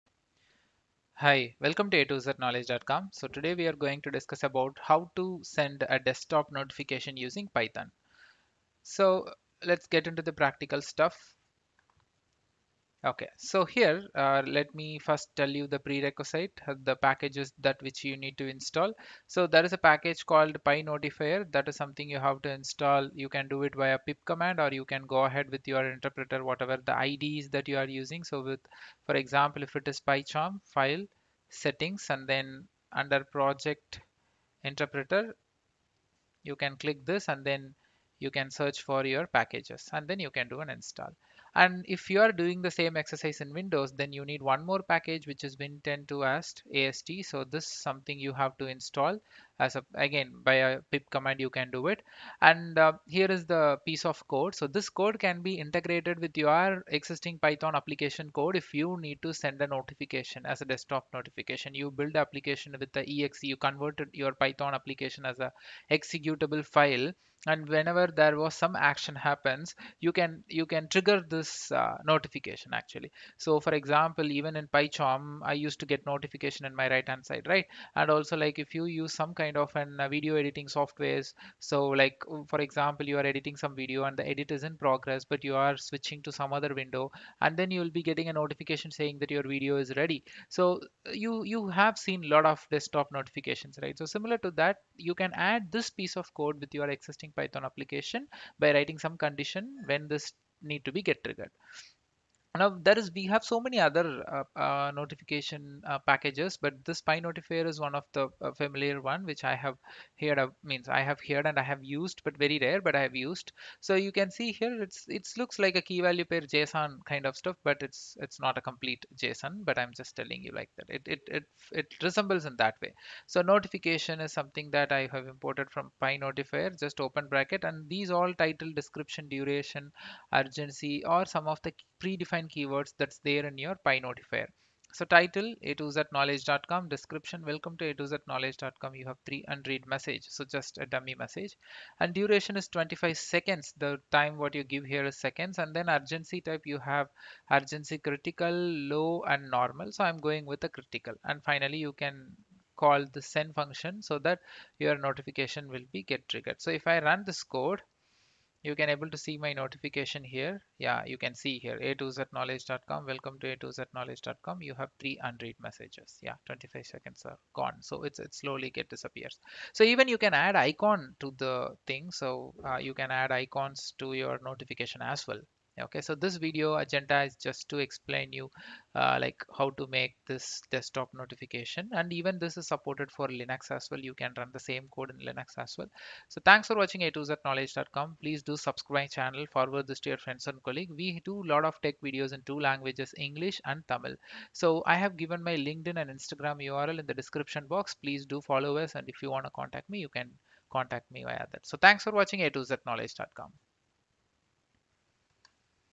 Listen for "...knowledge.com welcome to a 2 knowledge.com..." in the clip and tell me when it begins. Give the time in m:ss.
2:42.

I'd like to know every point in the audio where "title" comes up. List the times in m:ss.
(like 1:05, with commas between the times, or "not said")
2:08, 2:15.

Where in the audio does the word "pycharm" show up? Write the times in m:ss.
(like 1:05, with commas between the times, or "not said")
0:29, 1:14.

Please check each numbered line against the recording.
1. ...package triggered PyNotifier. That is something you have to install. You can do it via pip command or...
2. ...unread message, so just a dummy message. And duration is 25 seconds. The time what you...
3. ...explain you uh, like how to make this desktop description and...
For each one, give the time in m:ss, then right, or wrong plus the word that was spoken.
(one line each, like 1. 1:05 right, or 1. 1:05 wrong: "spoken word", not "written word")
1. 0:19 wrong: "called", not "triggered"
2. 2:19 right
3. 2:57 wrong: "notification", not "description".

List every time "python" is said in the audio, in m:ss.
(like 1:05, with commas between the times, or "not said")
0:07, 0:57, 1:04, 1:37.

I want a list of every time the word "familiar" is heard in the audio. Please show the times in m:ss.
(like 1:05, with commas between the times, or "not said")
1:48.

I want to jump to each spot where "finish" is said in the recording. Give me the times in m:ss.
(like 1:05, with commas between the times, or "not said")
not said.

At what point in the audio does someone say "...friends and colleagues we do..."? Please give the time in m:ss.
3:10.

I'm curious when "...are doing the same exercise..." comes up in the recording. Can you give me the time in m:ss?
0:42.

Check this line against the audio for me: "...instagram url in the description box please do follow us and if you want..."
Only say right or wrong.
right.